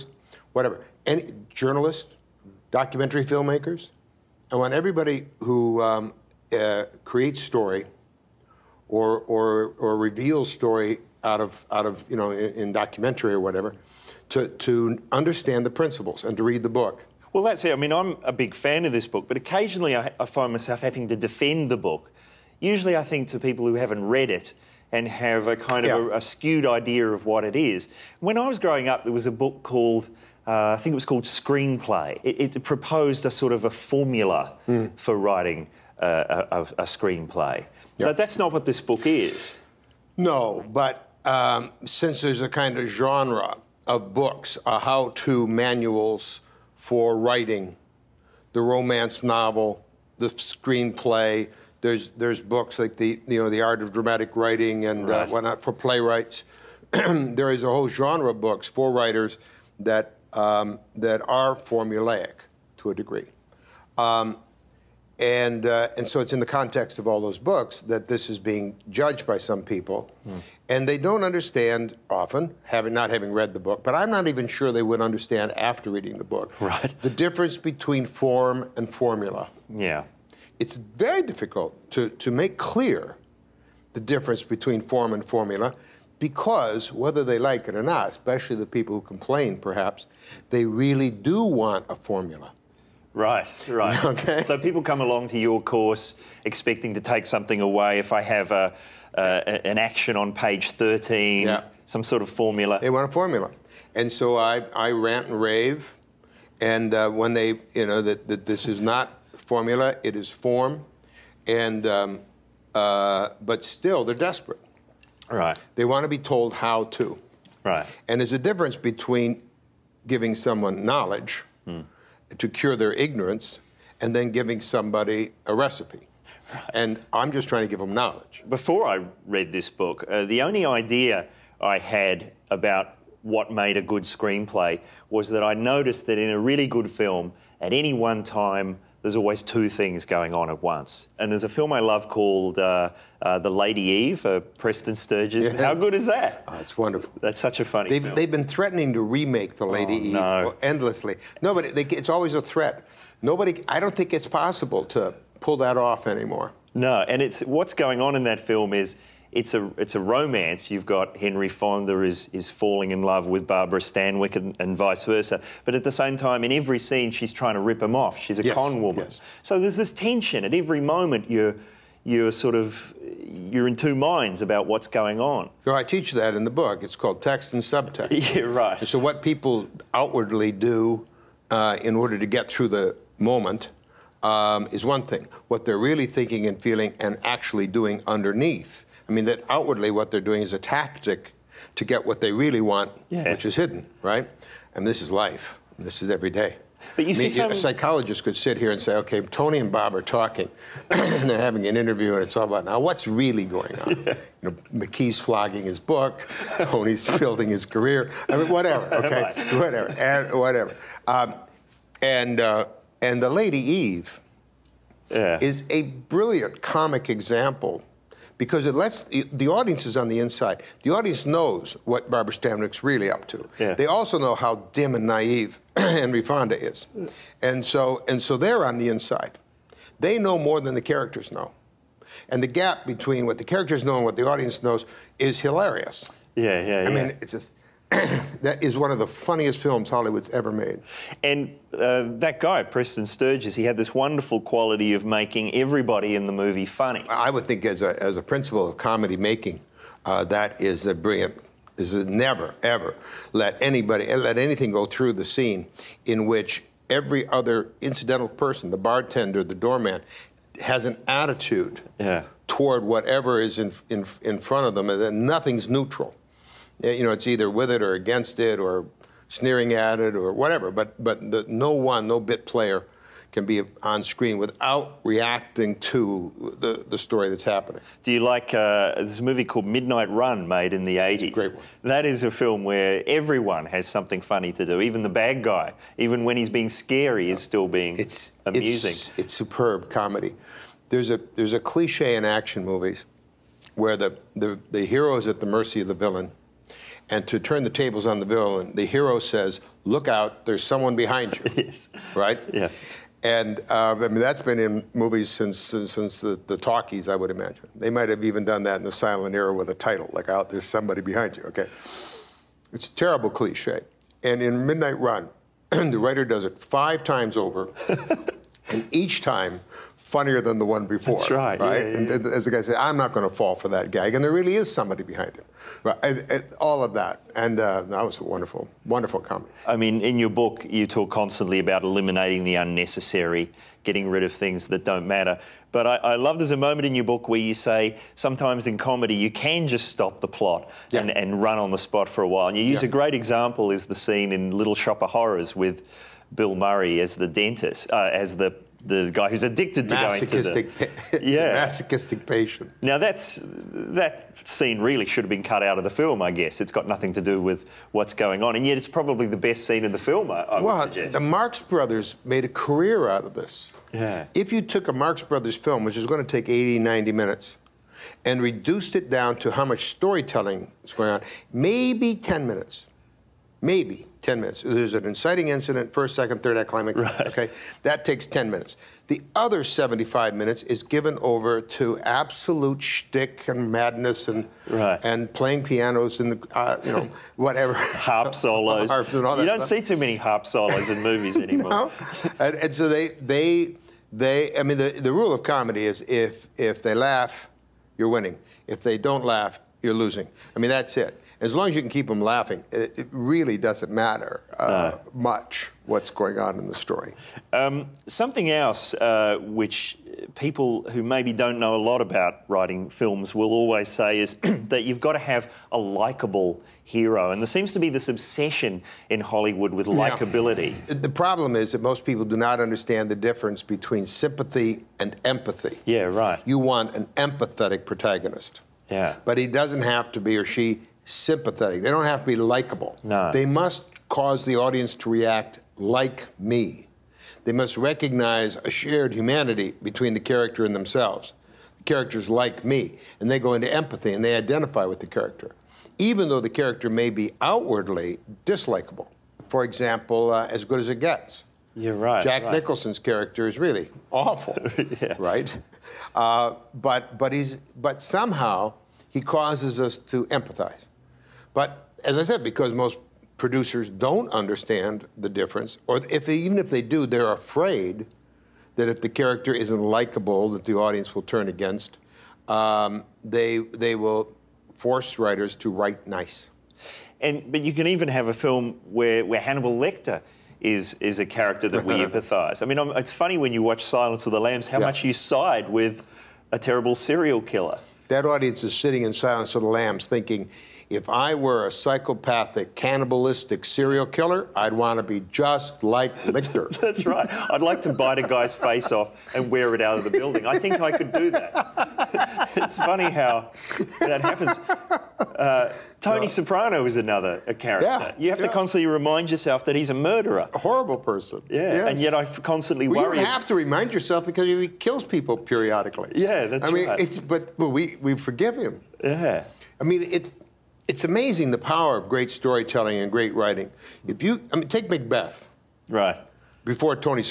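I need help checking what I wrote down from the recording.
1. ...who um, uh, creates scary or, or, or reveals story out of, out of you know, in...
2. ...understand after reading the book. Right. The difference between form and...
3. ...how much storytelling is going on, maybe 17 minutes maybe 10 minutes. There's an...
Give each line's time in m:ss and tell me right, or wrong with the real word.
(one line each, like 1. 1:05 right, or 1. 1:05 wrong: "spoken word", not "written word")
1. 0:05 wrong: "story", not "scary"
2. 1:15 right
3. 6:09 wrong: "10", not "17".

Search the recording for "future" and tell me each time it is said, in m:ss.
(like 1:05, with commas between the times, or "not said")
not said.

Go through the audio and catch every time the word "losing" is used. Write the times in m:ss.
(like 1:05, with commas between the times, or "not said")
6:39.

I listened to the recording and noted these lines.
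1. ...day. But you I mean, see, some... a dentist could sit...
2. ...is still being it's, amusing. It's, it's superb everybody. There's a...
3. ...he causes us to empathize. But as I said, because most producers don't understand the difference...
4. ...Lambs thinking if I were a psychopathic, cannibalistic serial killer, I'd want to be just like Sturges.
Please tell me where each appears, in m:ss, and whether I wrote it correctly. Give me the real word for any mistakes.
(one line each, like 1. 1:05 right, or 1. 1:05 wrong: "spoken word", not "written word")
1. 3:16 wrong: "psychologist", not "dentist"
2. 4:47 wrong: "comedy", not "everybody"
3. 7:39 right
4. 8:09 wrong: "Lecter", not "Sturges".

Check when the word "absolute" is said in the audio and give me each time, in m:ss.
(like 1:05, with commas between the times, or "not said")
6:21.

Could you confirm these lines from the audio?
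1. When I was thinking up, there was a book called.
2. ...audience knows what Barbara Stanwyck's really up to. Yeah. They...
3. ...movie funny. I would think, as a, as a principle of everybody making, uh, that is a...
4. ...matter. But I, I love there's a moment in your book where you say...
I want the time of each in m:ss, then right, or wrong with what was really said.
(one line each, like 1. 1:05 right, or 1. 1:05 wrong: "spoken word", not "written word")
1. 0:28 wrong: "growing", not "thinking"
2. 3:40 right
3. 4:06 wrong: "comedy", not "everybody"
4. 5:35 right.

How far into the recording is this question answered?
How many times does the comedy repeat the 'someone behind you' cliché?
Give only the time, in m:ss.
5:16.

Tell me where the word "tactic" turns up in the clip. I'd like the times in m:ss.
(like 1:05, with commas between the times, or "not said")
3:10.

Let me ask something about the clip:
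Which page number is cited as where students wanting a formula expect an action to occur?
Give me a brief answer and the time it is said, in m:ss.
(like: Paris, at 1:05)
13, at 1:40.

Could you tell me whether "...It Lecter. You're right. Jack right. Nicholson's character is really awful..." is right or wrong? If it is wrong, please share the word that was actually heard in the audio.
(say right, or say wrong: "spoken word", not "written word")
wrong: "Gets", not "Lecter".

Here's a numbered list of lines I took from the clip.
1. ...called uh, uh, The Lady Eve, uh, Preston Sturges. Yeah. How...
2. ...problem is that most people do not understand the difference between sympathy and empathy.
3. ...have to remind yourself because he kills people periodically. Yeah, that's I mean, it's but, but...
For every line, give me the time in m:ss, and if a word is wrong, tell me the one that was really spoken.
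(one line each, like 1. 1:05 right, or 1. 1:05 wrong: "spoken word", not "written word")
1. 2:22 right
2. 7:01 right
3. 8:33 right.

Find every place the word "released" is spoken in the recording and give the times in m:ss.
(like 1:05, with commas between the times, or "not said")
not said.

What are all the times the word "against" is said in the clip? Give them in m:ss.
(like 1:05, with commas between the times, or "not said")
4:27, 7:51.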